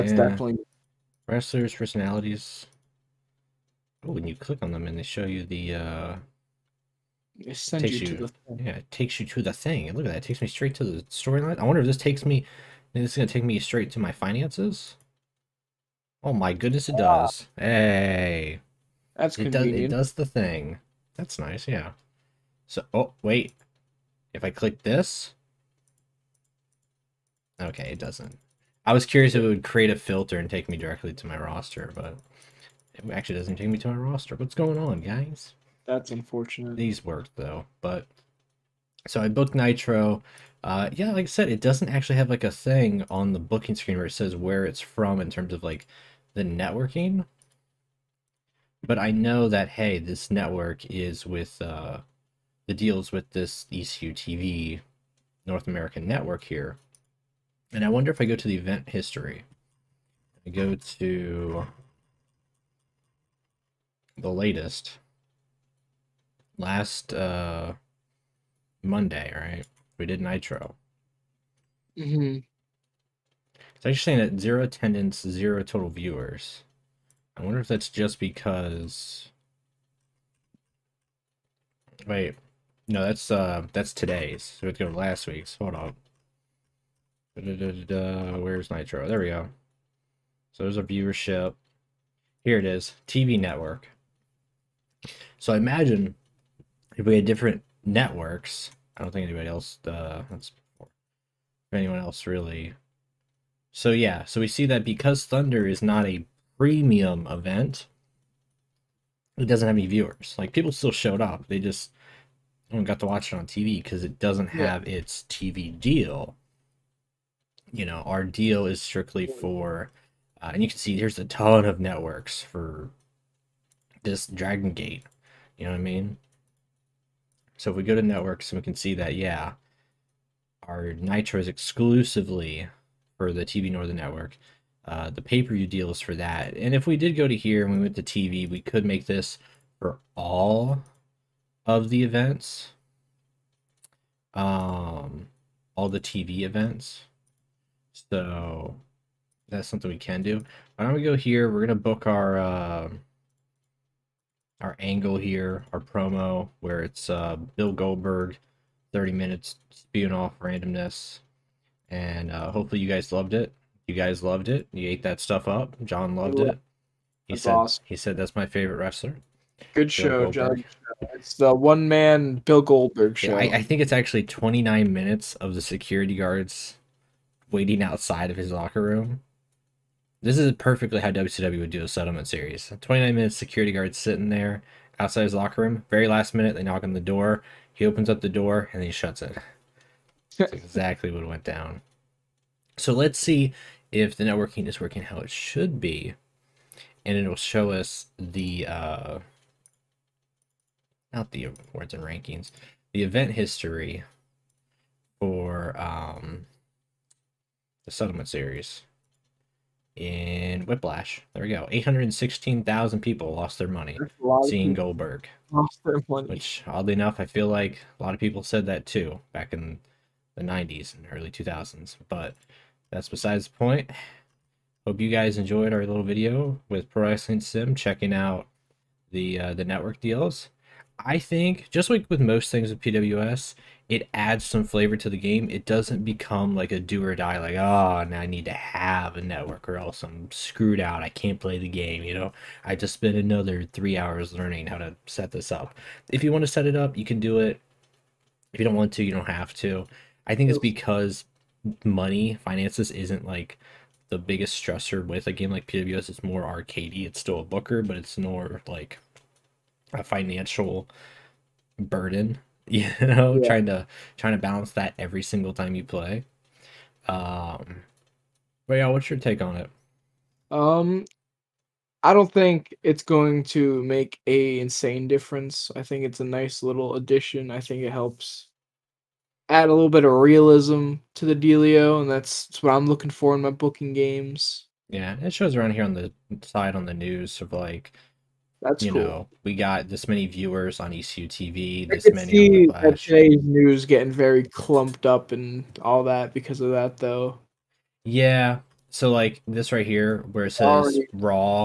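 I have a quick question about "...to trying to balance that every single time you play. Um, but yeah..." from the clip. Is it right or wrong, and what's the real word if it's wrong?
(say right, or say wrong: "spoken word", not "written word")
right.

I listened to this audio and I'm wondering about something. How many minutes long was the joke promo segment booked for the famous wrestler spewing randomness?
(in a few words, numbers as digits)
30.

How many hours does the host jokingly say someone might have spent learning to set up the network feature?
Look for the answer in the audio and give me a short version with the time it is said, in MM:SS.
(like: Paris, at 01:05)
3, at 04:03.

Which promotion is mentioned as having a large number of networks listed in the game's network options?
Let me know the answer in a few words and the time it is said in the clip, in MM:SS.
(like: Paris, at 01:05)
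Dragon Gate, at 02:04.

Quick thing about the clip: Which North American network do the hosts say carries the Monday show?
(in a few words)
ECU TV North American network.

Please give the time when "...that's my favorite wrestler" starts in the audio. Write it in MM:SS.
02:48.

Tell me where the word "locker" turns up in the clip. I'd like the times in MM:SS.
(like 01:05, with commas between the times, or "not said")
02:58, 03:05.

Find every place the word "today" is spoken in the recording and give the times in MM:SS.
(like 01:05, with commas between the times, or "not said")
01:23, 04:52.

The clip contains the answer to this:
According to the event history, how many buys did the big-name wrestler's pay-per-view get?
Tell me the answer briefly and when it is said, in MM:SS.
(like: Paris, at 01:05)
816,000, at 03:31.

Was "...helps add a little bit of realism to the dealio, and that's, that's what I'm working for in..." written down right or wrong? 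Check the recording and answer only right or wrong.
wrong.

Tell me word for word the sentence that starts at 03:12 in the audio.
So let's see if the networking is working how it should be.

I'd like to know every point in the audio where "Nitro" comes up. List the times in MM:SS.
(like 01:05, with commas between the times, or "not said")
00:39, 01:10, 01:28, 02:10.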